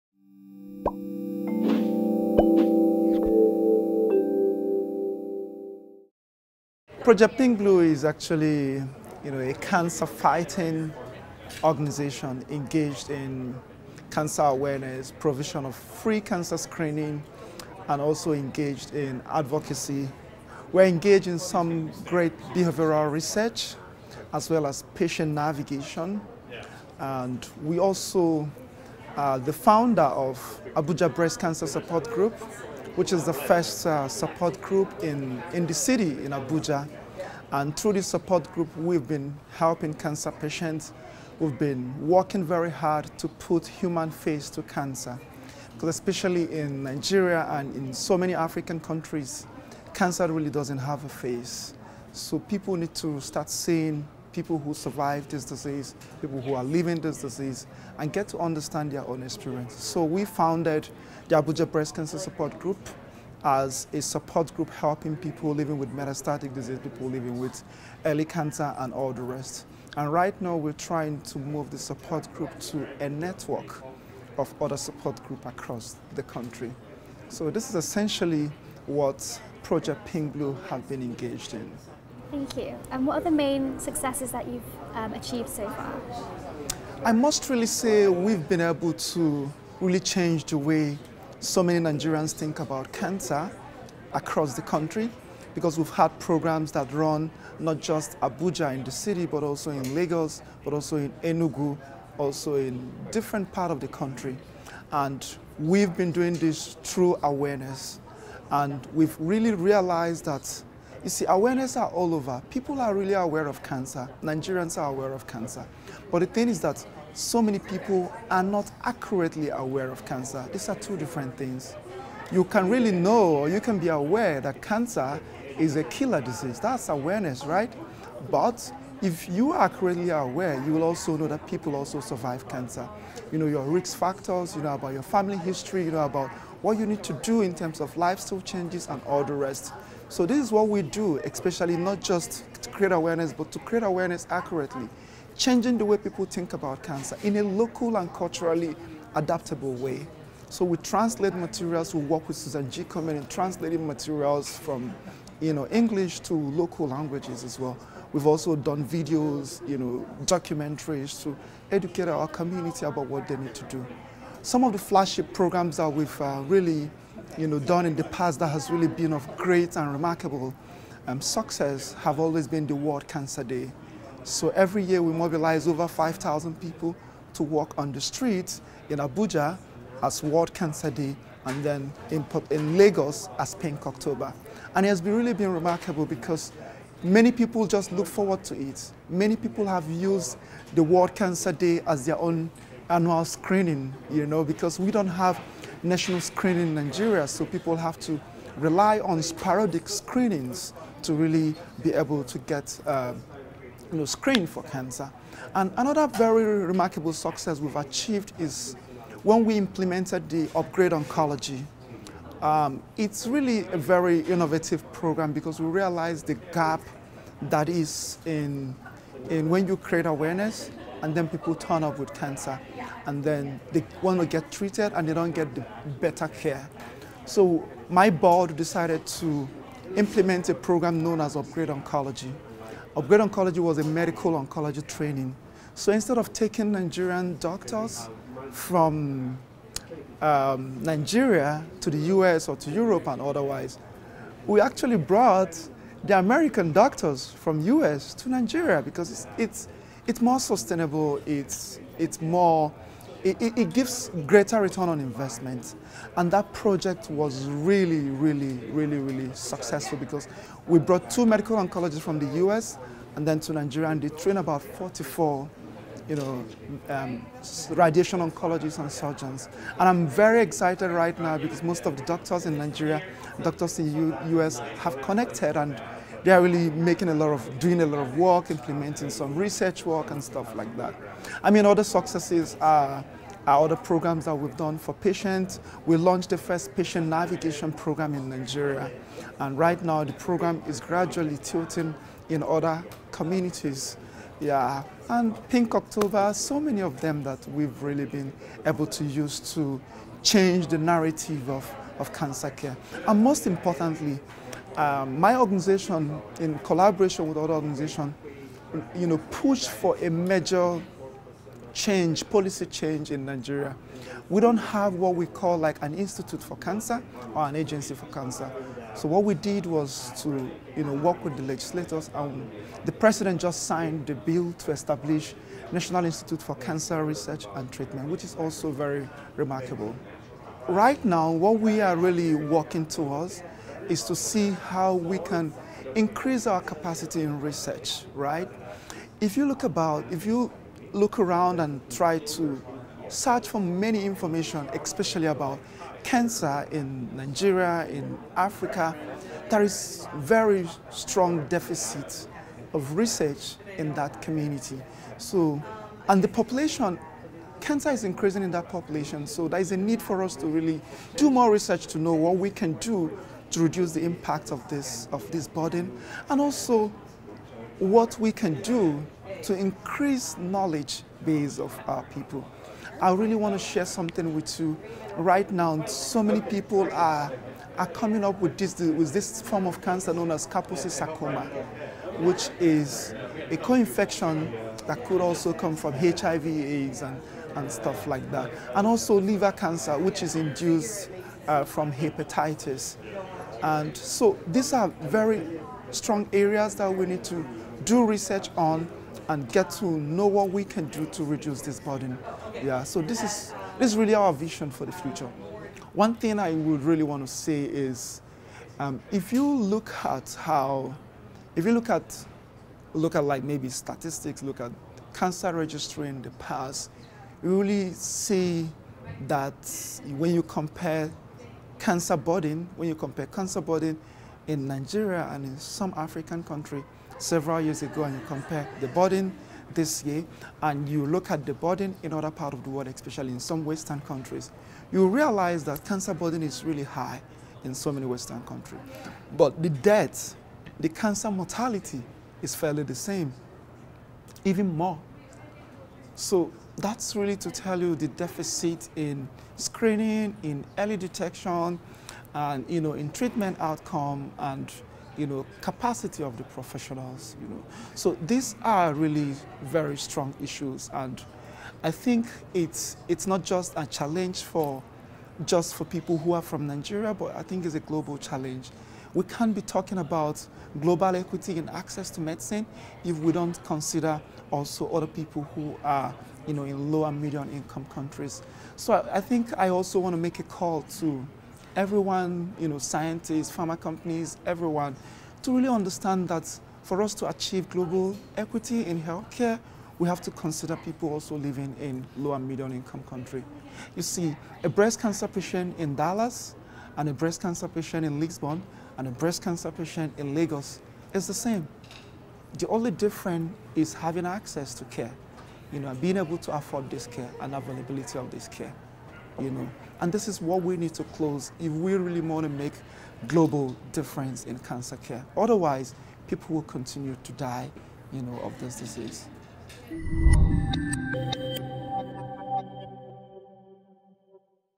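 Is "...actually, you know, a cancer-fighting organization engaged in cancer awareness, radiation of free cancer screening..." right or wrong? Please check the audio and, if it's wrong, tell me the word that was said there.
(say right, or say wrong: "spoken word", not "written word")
wrong: "provision", not "radiation".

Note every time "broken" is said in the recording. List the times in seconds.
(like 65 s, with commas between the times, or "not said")
not said.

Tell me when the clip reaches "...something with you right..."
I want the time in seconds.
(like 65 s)
373 s.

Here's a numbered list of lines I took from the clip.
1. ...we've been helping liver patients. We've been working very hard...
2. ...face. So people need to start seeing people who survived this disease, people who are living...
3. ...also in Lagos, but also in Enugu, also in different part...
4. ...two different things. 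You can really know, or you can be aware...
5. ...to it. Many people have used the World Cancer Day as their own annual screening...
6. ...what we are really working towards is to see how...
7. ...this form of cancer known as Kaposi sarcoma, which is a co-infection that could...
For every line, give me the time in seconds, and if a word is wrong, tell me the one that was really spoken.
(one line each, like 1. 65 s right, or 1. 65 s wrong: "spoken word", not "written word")
1. 38 s wrong: "cancer", not "liver"
2. 51 s right
3. 99 s right
4. 120 s right
5. 188 s right
6. 331 s right
7. 379 s right.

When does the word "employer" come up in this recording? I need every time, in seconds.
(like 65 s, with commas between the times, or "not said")
not said.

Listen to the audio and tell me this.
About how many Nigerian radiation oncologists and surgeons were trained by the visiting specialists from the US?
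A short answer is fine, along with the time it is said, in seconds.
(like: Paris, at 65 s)
44, at 264 s.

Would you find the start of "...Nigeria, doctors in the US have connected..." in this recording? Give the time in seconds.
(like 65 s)
272 s.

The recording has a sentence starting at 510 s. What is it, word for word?
And this is what we need to close if we really want to make global difference in cancer care.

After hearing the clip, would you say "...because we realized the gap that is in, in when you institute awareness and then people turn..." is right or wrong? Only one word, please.
wrong.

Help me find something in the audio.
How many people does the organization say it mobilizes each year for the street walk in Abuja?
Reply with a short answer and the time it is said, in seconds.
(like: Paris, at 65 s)
over 5,000, at 175 s.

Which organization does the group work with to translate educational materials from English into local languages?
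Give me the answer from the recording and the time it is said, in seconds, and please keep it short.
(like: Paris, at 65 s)
Susan G. Komen, at 152 s.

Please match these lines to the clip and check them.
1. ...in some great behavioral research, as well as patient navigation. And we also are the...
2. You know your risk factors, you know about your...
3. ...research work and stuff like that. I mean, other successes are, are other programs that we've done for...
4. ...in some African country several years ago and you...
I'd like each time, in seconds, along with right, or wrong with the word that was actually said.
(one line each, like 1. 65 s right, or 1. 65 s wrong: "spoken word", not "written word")
1. 21 s right
2. 133 s right
3. 279 s right
4. 425 s right.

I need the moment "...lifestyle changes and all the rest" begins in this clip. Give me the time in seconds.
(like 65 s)
137 s.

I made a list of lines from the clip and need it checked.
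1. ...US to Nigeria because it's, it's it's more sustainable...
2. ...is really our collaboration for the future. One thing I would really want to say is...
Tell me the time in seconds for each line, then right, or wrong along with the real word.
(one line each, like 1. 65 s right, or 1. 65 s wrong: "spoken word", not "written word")
1. 247 s right
2. 403 s wrong: "vision", not "collaboration".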